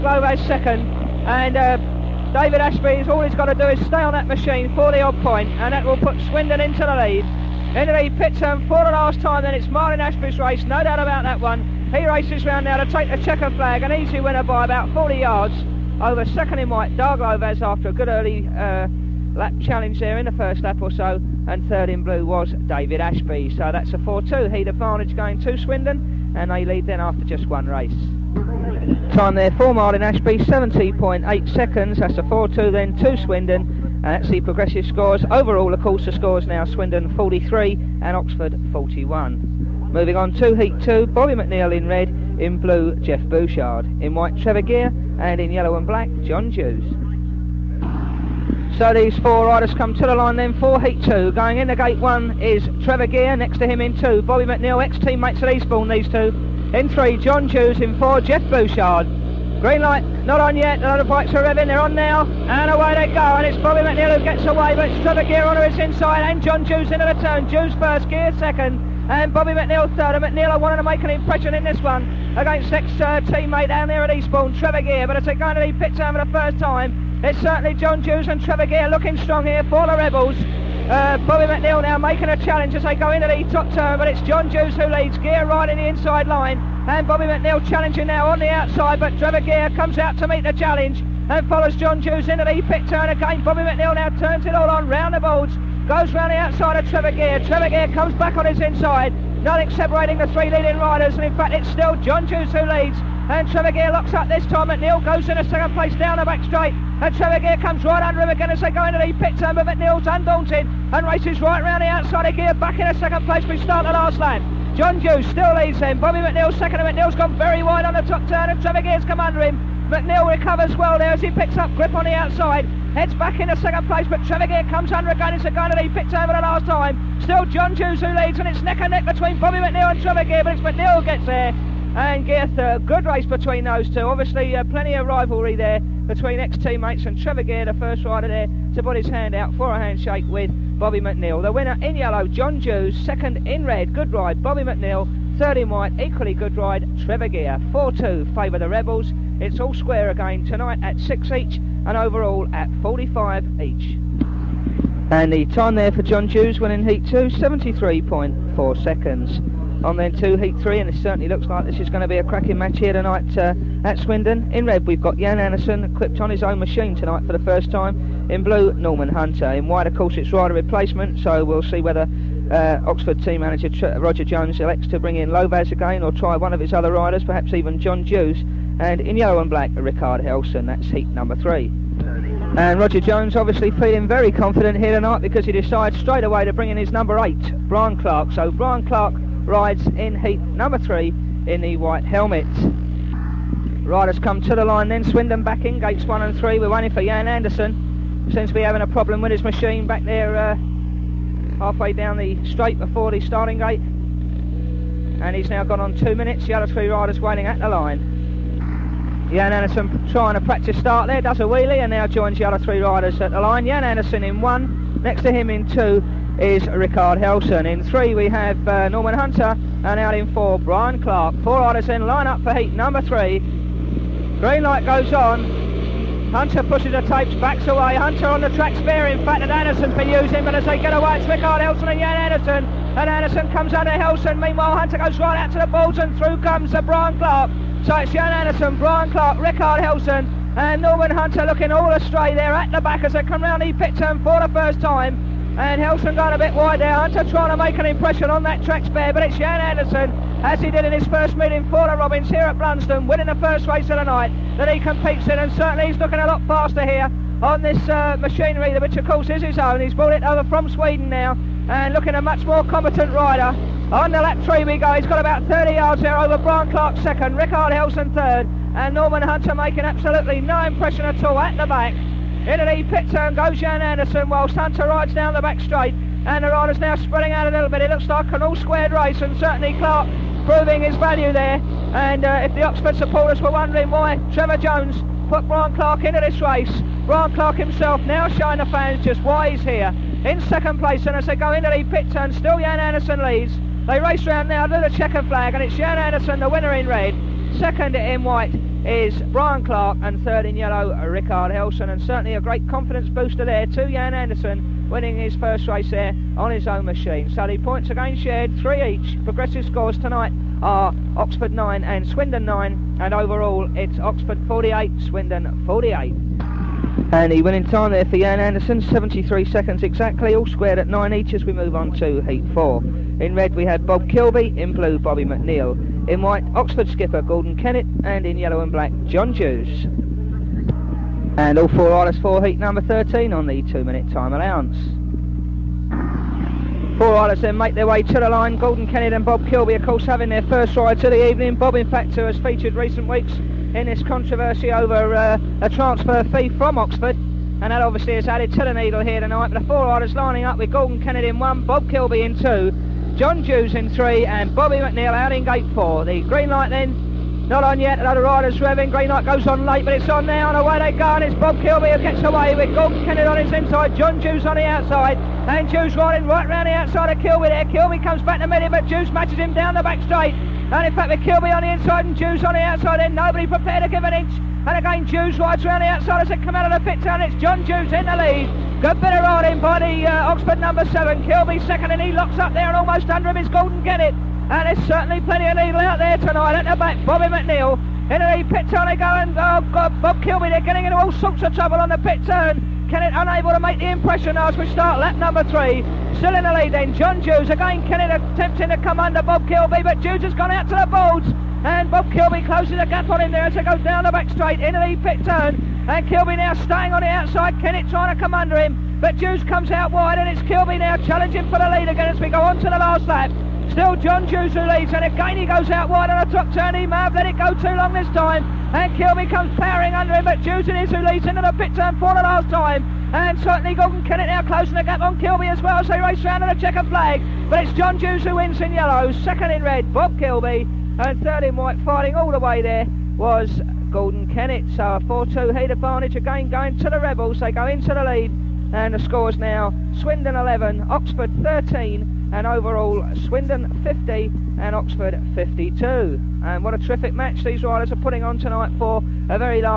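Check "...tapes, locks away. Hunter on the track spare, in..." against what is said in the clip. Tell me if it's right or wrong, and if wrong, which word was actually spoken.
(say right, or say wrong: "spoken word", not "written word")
wrong: "backs", not "locks".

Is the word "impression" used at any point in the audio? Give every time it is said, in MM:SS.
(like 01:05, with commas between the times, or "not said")
01:11, 04:07, 04:30, 06:33.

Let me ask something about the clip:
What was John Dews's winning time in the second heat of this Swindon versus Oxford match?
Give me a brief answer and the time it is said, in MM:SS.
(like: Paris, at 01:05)
73.4 seconds, at 02:37.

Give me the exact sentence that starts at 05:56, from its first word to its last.
The green light then not on yet, another rider's swerving.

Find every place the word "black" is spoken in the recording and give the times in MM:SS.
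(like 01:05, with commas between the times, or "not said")
00:45, 02:59, 05:28.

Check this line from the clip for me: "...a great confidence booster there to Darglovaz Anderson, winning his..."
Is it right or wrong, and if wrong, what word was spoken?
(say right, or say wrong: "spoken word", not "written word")
wrong: "Jan", not "Darglovaz".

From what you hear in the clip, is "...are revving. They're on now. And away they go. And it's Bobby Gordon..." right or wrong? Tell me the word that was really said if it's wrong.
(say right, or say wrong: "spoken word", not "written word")
wrong: "McNeil", not "Gordon".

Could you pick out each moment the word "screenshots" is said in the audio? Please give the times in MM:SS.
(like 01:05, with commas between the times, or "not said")
not said.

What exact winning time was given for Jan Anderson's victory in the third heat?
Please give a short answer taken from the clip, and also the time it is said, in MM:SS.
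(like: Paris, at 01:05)
73 seconds, at 05:18.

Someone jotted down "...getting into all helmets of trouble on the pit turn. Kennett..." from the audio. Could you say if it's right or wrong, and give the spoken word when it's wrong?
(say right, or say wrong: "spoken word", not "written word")
wrong: "sorts", not "helmets".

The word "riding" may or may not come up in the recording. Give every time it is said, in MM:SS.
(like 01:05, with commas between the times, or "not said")
06:05, 06:19.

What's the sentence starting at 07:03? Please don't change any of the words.
And certainly Gordon Kennett now closing the gap on Kilby as well as they race round on a checkered flag.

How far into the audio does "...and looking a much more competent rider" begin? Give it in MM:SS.
04:21.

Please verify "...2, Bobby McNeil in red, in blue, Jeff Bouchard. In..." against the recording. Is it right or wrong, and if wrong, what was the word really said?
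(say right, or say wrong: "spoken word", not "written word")
right.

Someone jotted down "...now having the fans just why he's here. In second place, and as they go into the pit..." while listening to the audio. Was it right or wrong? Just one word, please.
wrong.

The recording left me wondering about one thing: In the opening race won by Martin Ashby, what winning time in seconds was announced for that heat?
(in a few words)
70.8 seconds.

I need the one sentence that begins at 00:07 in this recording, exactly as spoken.
Then he pit turn for the last time, then it's Martin Ashby's race, no doubt about that one.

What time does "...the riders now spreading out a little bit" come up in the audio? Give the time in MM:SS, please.
04:36.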